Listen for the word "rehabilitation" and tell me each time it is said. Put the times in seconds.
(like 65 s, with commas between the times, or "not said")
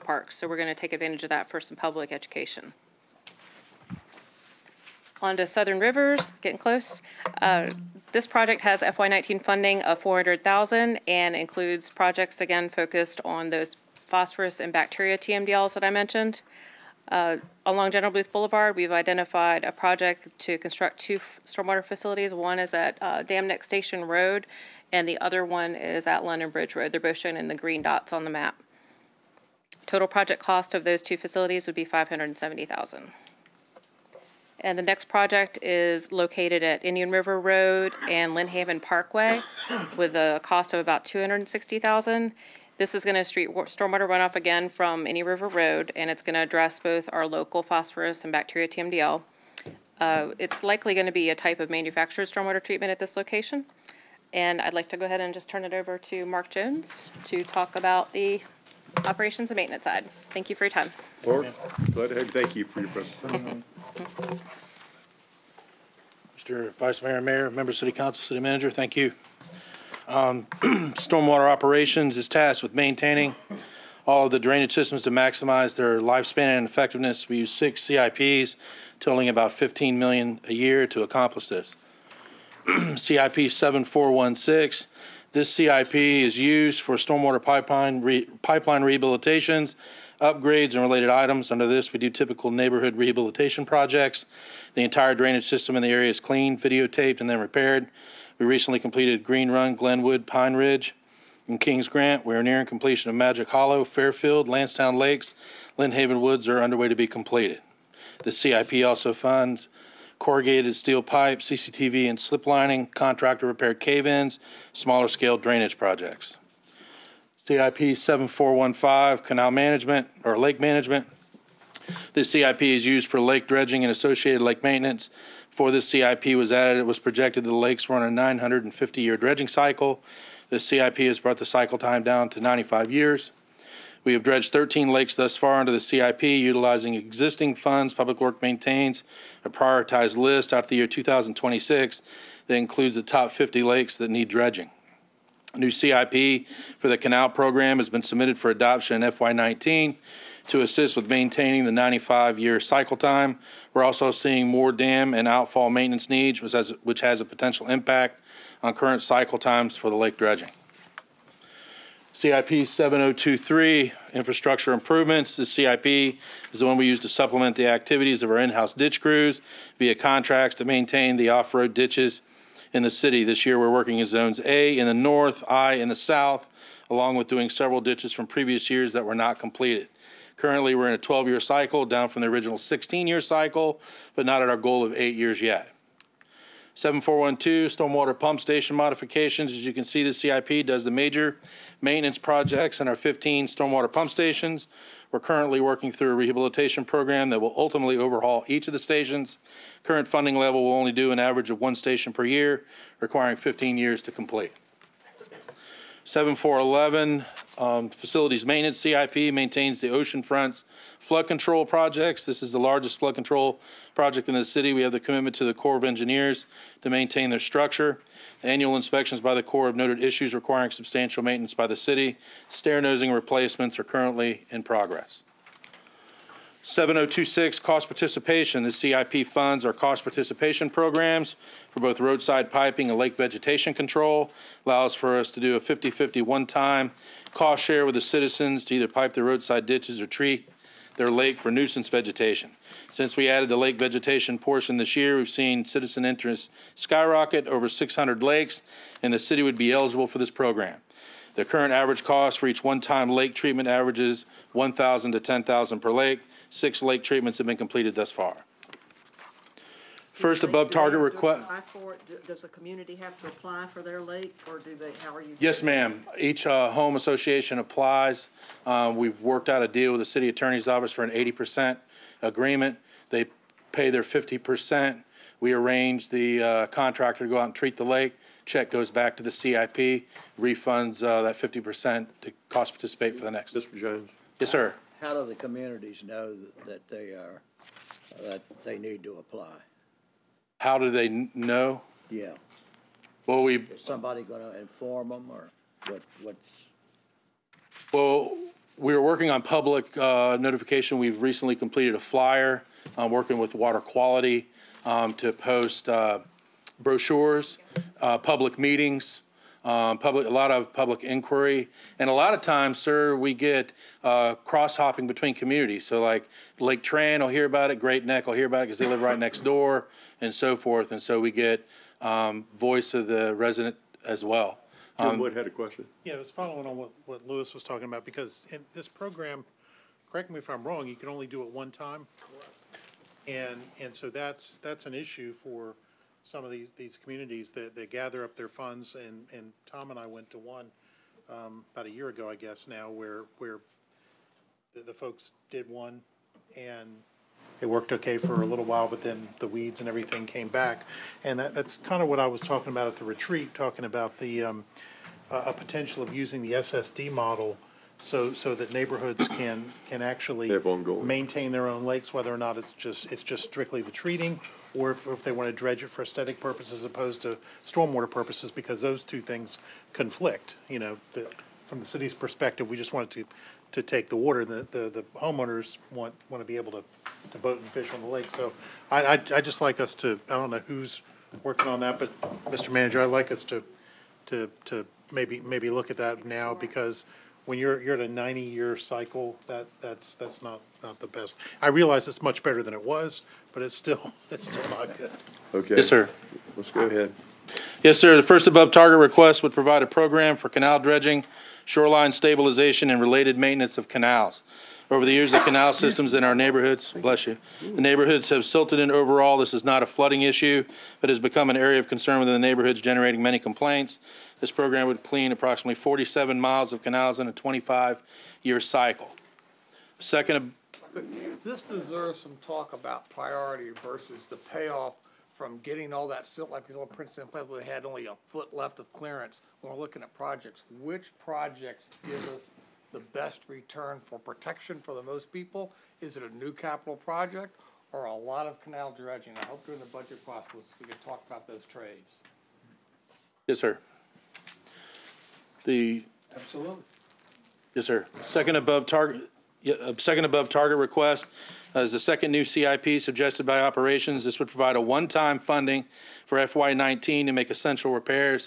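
88 s, 92 s, 196 s.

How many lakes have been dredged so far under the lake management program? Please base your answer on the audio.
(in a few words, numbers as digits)
13.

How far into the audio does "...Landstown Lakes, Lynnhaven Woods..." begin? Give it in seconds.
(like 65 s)
104 s.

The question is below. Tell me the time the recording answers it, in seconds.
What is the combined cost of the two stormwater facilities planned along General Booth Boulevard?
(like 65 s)
31 s.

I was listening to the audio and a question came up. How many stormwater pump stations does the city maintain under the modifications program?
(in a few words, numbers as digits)
15.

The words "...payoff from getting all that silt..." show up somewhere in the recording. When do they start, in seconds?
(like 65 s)
424 s.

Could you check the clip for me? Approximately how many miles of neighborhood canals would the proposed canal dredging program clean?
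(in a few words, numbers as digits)
47 miles.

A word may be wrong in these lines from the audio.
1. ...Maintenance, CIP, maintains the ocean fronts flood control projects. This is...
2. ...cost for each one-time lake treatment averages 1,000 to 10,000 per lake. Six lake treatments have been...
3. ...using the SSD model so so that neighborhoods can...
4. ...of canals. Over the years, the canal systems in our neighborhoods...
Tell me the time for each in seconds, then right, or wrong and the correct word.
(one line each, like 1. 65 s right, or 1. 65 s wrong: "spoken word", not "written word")
1. 208 s right
2. 252 s right
3. 356 s right
4. 403 s right.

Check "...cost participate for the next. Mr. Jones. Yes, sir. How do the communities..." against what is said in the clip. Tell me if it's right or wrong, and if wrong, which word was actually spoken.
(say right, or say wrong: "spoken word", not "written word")
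right.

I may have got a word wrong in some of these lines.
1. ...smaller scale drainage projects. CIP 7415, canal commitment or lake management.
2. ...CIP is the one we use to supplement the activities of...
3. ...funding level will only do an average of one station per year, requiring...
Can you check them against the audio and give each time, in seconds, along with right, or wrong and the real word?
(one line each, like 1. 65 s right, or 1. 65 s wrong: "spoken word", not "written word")
1. 114 s wrong: "management", not "commitment"
2. 165 s right
3. 200 s right.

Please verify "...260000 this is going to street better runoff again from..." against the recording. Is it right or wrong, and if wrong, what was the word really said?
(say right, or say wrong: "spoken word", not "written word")
wrong: "stormwater", not "better".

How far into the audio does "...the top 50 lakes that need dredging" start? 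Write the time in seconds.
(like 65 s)
142 s.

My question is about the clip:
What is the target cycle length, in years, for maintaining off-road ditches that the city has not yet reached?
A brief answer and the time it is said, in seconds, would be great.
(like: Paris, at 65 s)
8 years, at 184 s.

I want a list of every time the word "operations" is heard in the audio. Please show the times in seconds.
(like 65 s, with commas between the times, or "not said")
59 s, 71 s, 453 s.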